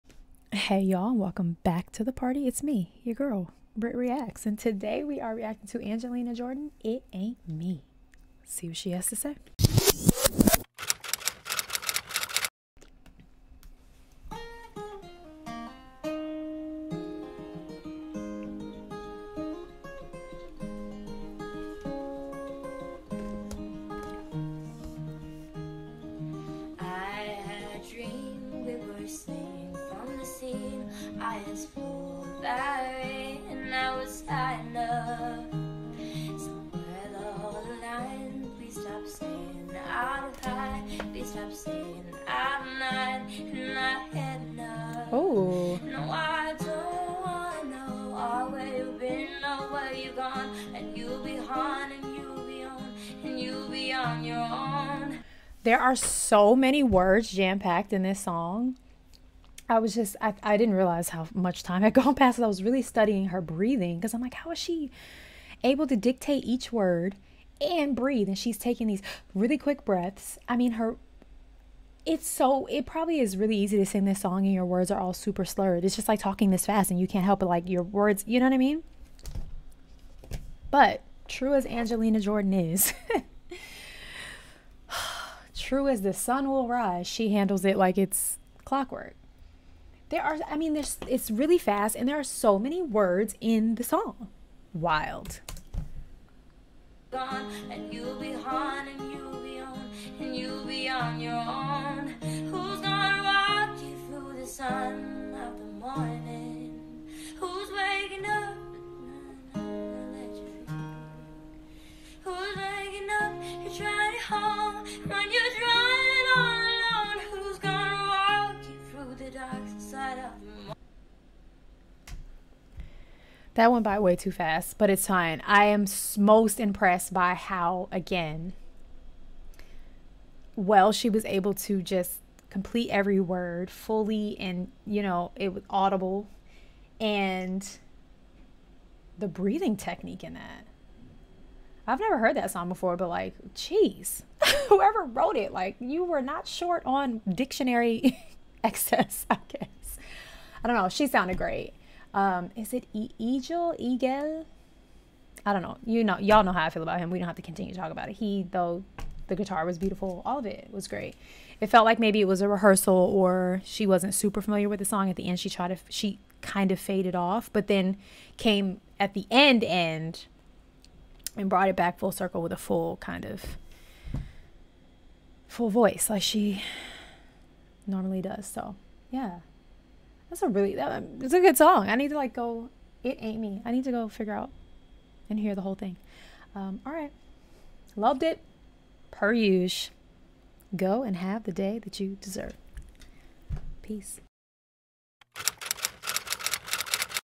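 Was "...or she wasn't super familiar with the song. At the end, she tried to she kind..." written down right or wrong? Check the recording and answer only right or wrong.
right.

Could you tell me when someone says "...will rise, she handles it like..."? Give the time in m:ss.
1:26.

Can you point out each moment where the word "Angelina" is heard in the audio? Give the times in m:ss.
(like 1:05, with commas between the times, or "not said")
0:05, 1:21.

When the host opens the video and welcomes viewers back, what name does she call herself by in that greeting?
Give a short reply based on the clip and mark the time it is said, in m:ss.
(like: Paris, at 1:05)
Britt Reacts, at 0:03.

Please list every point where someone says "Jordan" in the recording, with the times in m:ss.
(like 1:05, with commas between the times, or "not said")
0:06, 1:22.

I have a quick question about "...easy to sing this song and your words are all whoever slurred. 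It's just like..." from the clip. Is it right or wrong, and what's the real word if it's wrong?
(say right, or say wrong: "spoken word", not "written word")
wrong: "super", not "whoever".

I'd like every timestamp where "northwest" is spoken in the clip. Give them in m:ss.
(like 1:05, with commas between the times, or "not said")
not said.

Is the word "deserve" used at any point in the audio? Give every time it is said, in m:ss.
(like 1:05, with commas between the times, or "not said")
3:12.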